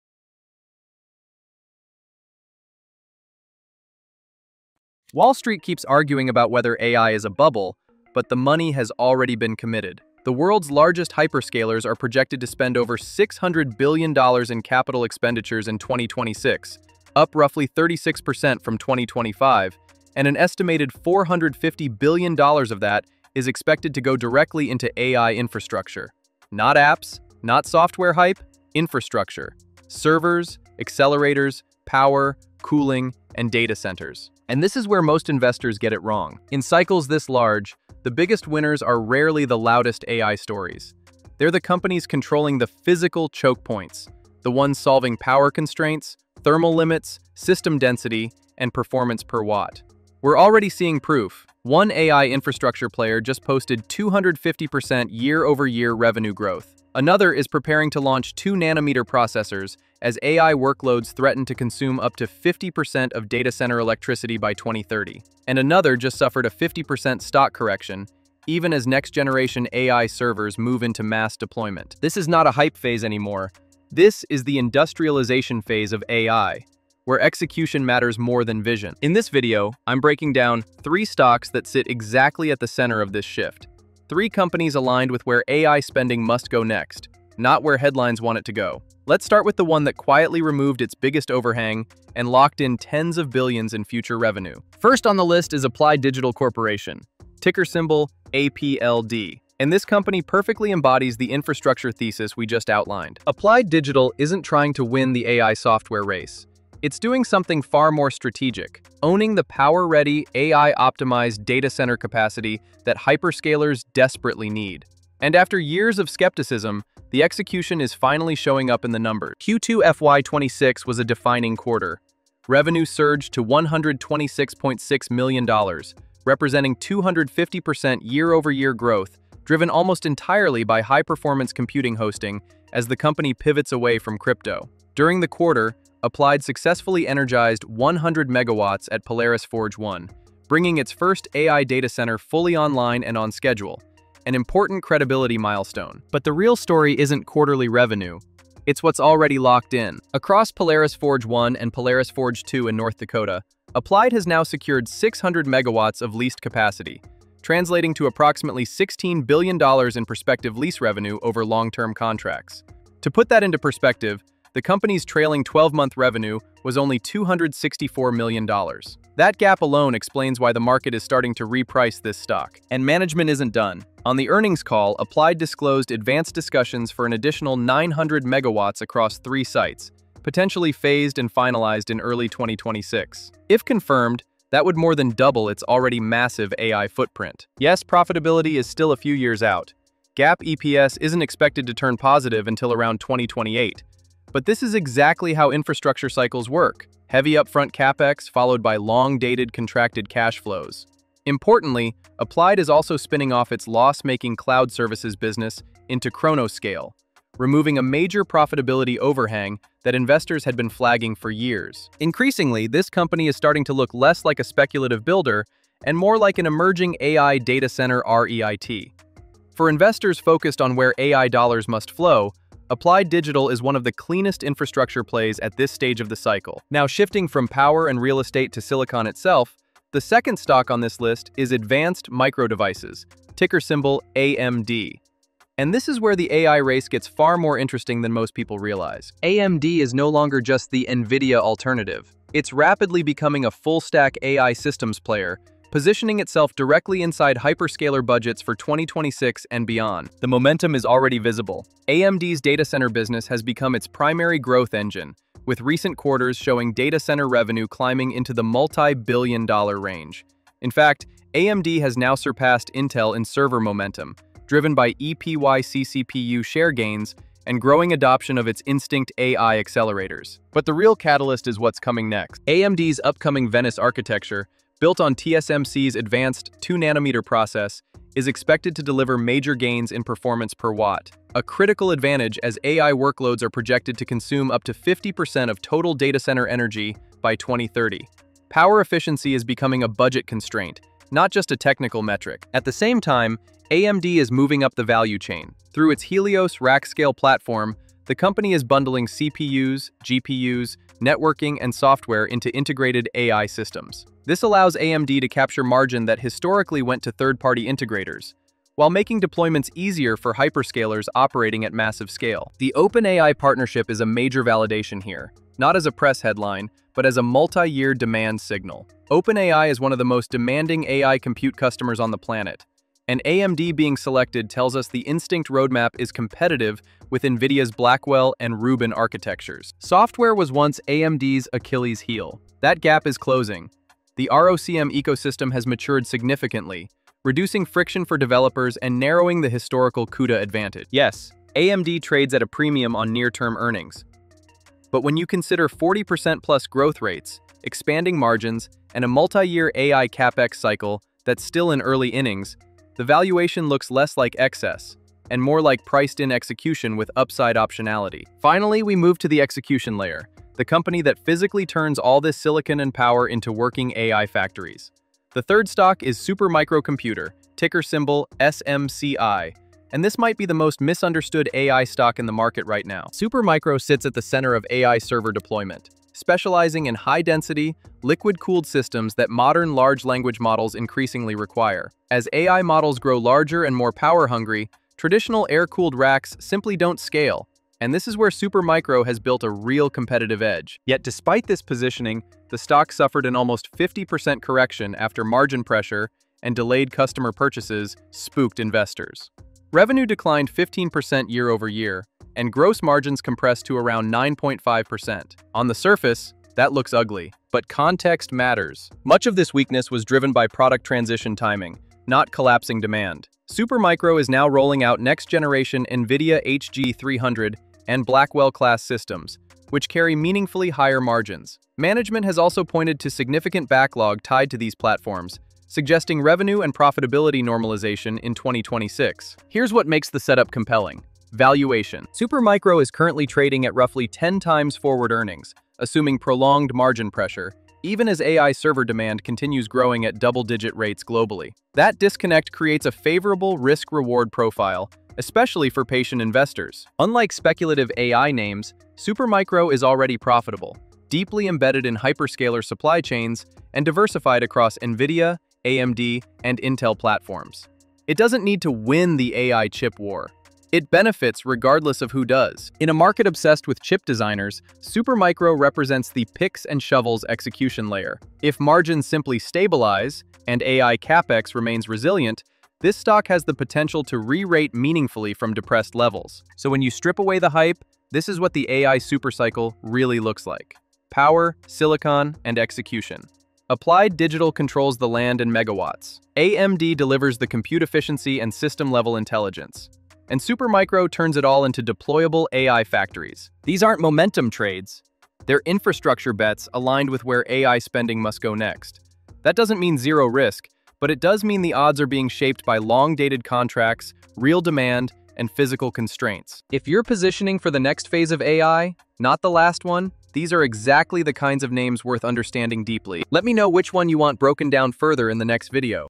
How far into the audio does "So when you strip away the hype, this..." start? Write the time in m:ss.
7:56.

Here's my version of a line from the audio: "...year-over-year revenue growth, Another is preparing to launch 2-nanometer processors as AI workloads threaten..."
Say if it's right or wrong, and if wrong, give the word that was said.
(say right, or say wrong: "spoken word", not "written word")
right.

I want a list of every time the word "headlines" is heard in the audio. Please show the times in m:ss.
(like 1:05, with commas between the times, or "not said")
1:27, 5:16.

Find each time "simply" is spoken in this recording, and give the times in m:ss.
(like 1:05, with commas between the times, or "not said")
6:26, 7:49.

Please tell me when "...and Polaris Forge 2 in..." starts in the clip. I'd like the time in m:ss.
2:31.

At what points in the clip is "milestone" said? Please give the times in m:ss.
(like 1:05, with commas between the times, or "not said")
2:25.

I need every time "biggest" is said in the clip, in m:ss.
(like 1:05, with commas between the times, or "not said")
0:38, 1:30.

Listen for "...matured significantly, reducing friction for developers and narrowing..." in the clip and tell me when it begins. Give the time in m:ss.
5:35.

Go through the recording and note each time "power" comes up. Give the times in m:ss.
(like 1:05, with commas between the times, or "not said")
0:31, 0:45, 1:49, 3:47, 4:48, 6:02, 6:23, 8:01.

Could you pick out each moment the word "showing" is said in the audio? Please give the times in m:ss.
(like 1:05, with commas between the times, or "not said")
1:58, 4:16.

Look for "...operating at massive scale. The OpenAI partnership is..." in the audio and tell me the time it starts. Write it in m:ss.
5:11.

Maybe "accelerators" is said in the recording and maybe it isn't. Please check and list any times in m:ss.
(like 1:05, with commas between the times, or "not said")
0:30, 4:29.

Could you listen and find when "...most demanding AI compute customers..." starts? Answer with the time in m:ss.
5:20.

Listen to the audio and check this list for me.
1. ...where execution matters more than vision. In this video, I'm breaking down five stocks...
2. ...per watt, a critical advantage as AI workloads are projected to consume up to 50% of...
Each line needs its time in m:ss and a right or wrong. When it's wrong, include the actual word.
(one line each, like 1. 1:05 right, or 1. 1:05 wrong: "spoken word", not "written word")
1. 1:17 wrong: "three", not "five"
2. 4:40 right.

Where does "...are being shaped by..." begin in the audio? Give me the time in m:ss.
8:22.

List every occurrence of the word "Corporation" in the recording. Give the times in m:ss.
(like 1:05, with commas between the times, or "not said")
1:36.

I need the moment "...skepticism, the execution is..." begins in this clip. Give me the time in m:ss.
1:56.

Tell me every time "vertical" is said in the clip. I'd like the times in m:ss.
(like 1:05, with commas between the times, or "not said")
not said.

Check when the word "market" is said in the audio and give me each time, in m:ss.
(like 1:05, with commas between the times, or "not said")
2:50, 6:12, 7:42.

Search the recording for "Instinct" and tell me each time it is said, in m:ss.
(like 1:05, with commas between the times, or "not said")
4:28, 5:25.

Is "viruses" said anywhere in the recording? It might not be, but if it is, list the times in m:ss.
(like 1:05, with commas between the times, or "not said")
not said.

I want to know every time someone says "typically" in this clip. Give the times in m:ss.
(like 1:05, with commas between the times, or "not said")
not said.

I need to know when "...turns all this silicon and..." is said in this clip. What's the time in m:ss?
6:01.